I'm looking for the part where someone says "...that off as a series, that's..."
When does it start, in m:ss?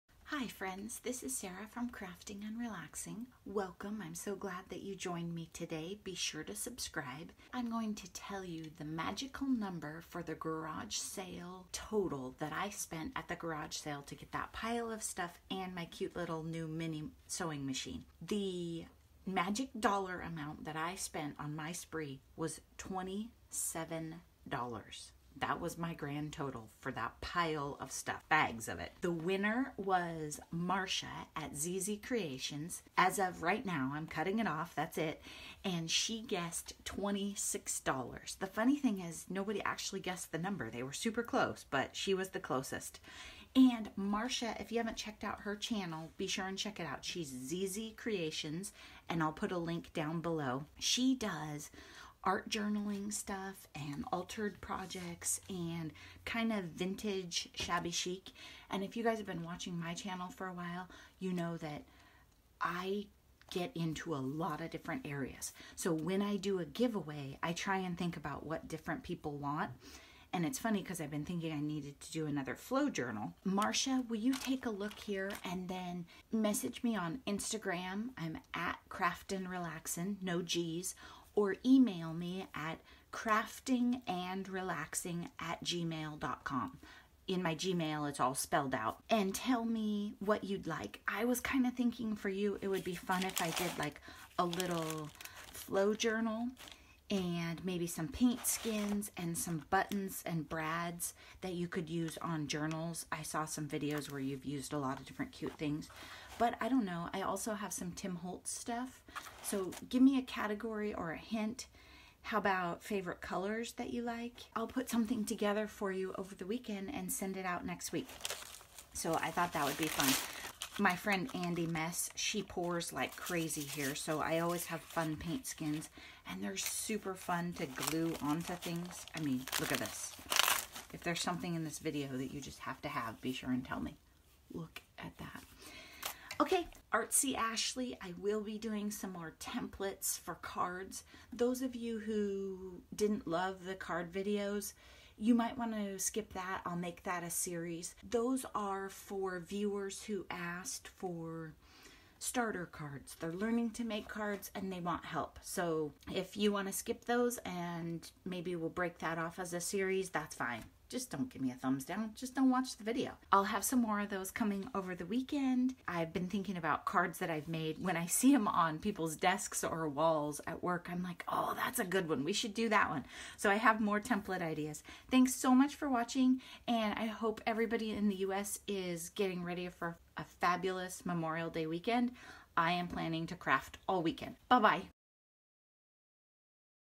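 2:38.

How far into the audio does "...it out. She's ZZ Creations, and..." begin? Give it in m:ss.
0:46.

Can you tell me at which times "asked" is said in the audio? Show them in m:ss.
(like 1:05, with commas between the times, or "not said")
2:30.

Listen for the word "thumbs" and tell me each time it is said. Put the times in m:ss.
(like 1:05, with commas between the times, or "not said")
2:41.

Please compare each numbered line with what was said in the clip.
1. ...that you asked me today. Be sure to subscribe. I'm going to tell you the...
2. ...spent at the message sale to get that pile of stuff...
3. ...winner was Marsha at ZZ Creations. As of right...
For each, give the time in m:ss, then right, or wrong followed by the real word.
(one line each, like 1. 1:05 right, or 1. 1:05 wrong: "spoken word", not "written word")
1. 0:04 wrong: "joined", not "asked"
2. 0:12 wrong: "garage", not "message"
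3. 0:29 right.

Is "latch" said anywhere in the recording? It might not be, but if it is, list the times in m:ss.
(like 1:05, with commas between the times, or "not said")
not said.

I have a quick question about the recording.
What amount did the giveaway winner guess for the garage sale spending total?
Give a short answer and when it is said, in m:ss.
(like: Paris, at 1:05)
$26, at 0:36.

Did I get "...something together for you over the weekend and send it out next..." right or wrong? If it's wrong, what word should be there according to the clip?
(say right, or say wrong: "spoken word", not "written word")
right.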